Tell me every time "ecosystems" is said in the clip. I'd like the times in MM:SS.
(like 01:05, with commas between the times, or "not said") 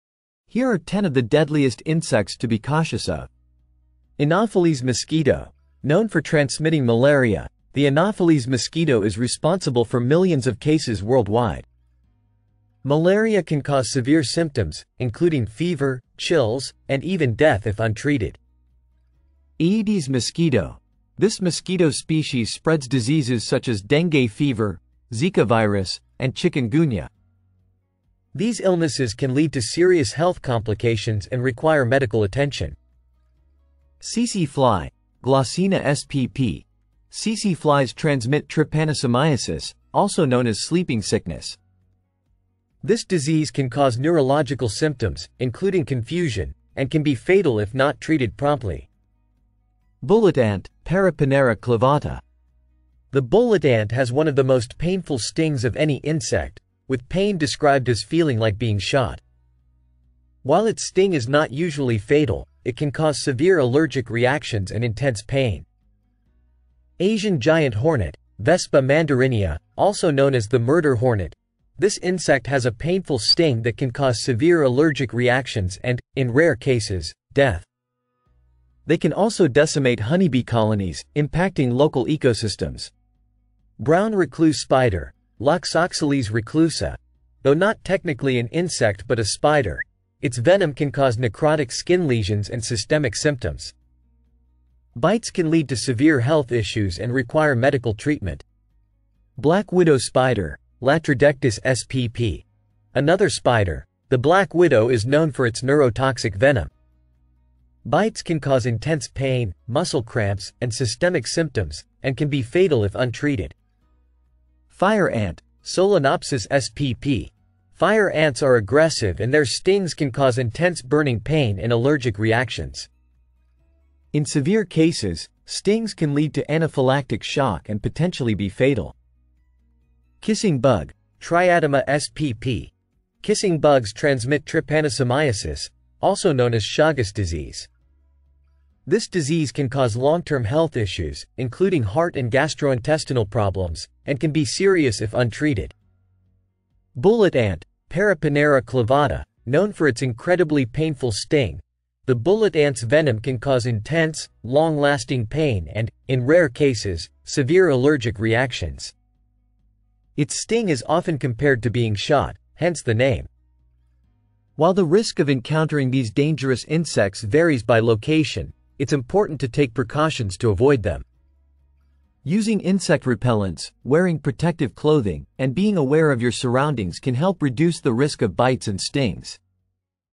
01:22.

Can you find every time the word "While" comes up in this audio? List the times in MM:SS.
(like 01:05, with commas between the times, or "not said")
01:00, 02:44.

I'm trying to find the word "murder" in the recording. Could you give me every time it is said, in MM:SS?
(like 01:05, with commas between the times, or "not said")
01:10.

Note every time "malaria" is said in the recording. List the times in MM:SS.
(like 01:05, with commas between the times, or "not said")
00:06, 00:12.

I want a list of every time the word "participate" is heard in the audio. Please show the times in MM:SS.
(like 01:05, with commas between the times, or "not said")
not said.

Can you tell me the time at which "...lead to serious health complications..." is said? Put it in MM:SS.
00:29.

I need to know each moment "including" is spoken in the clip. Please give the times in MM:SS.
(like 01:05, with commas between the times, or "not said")
00:14, 00:45, 02:21.